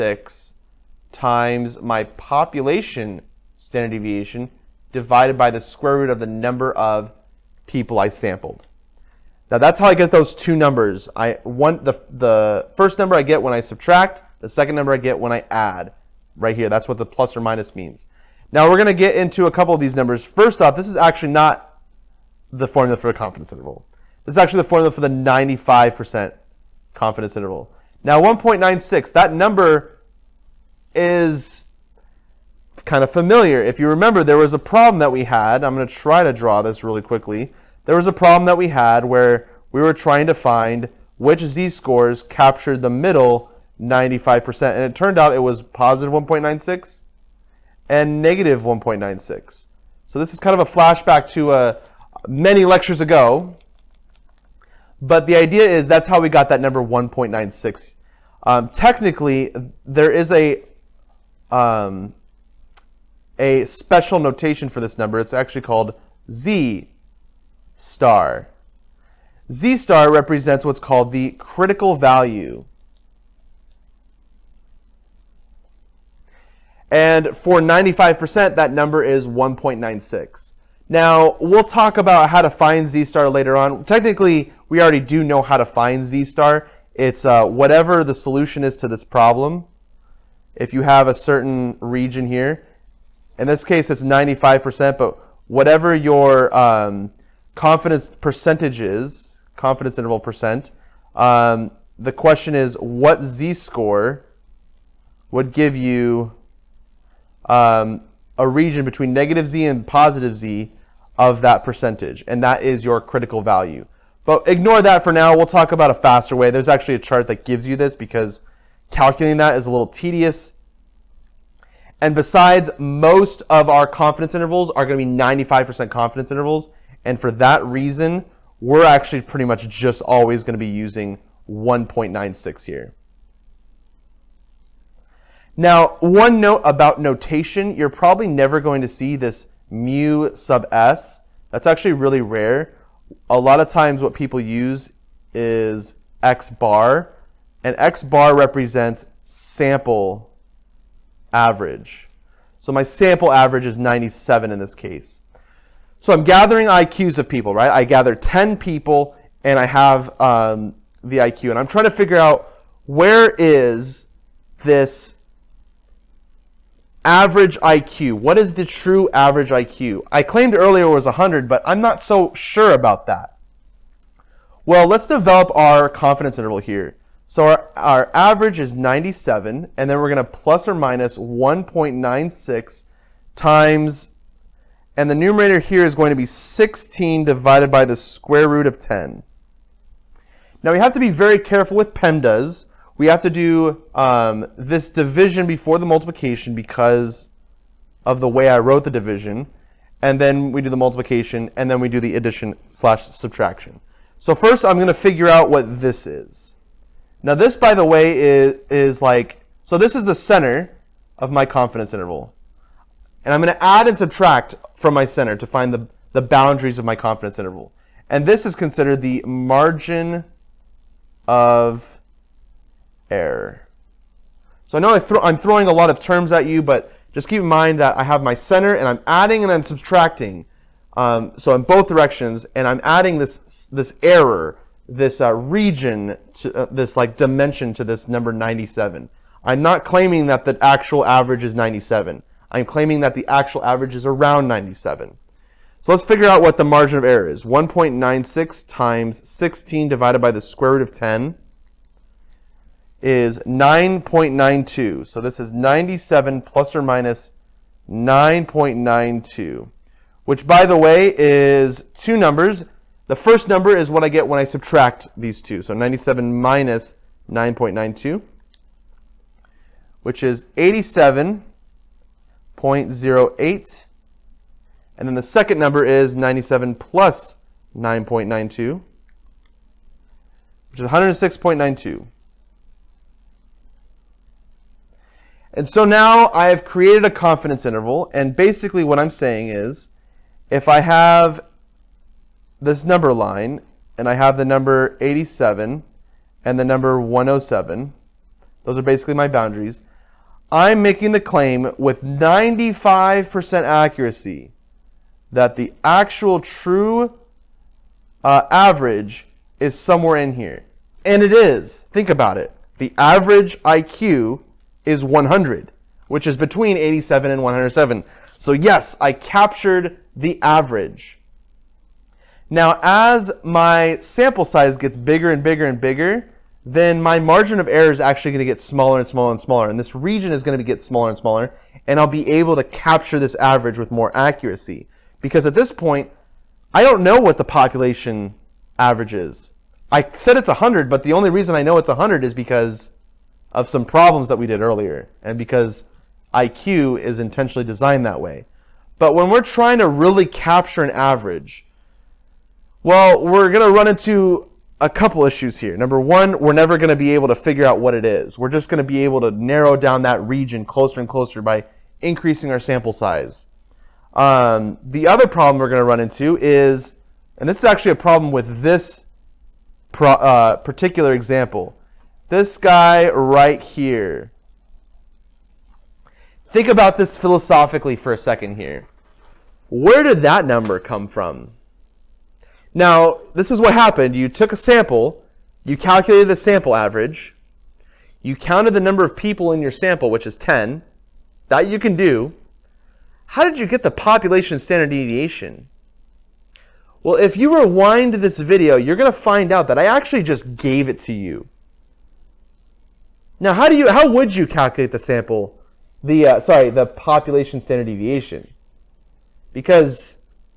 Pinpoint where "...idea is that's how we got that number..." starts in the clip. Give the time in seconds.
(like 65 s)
55 s.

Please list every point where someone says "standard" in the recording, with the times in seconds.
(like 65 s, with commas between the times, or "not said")
3 s, 394 s, 407 s.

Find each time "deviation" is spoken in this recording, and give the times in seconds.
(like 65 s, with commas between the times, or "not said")
3 s, 394 s, 407 s.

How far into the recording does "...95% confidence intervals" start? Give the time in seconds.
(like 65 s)
125 s.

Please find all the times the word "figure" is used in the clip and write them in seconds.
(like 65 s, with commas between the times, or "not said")
161 s, 204 s, 246 s, 357 s.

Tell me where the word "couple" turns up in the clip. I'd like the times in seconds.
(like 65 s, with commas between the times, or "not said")
19 s, 354 s.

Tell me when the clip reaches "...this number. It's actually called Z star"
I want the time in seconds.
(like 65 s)
64 s.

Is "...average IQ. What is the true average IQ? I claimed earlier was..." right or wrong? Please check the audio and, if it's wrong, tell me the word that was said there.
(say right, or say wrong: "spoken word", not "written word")
right.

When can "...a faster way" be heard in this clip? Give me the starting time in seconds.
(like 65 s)
115 s.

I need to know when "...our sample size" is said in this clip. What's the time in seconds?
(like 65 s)
362 s.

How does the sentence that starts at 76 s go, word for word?
And for 95%, that number is 1.96.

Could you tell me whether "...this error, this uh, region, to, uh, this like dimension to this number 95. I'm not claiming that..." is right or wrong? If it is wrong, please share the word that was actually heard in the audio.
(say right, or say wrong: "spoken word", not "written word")
wrong: "97", not "95".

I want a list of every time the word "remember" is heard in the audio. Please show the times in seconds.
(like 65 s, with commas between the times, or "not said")
33 s.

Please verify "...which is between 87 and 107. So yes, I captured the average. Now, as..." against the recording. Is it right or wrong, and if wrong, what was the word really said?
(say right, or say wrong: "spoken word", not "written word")
right.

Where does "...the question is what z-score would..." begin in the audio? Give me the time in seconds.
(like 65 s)
102 s.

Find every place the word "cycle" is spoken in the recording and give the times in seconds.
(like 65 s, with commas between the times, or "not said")
not said.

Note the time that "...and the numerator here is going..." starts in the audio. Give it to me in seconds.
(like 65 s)
184 s.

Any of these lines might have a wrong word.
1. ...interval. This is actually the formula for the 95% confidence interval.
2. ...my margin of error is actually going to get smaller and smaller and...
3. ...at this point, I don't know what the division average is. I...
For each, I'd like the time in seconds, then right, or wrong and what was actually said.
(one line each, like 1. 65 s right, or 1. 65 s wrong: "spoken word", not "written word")
1. 23 s right
2. 327 s right
3. 335 s wrong: "population", not "division".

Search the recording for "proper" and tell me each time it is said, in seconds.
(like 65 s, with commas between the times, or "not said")
not said.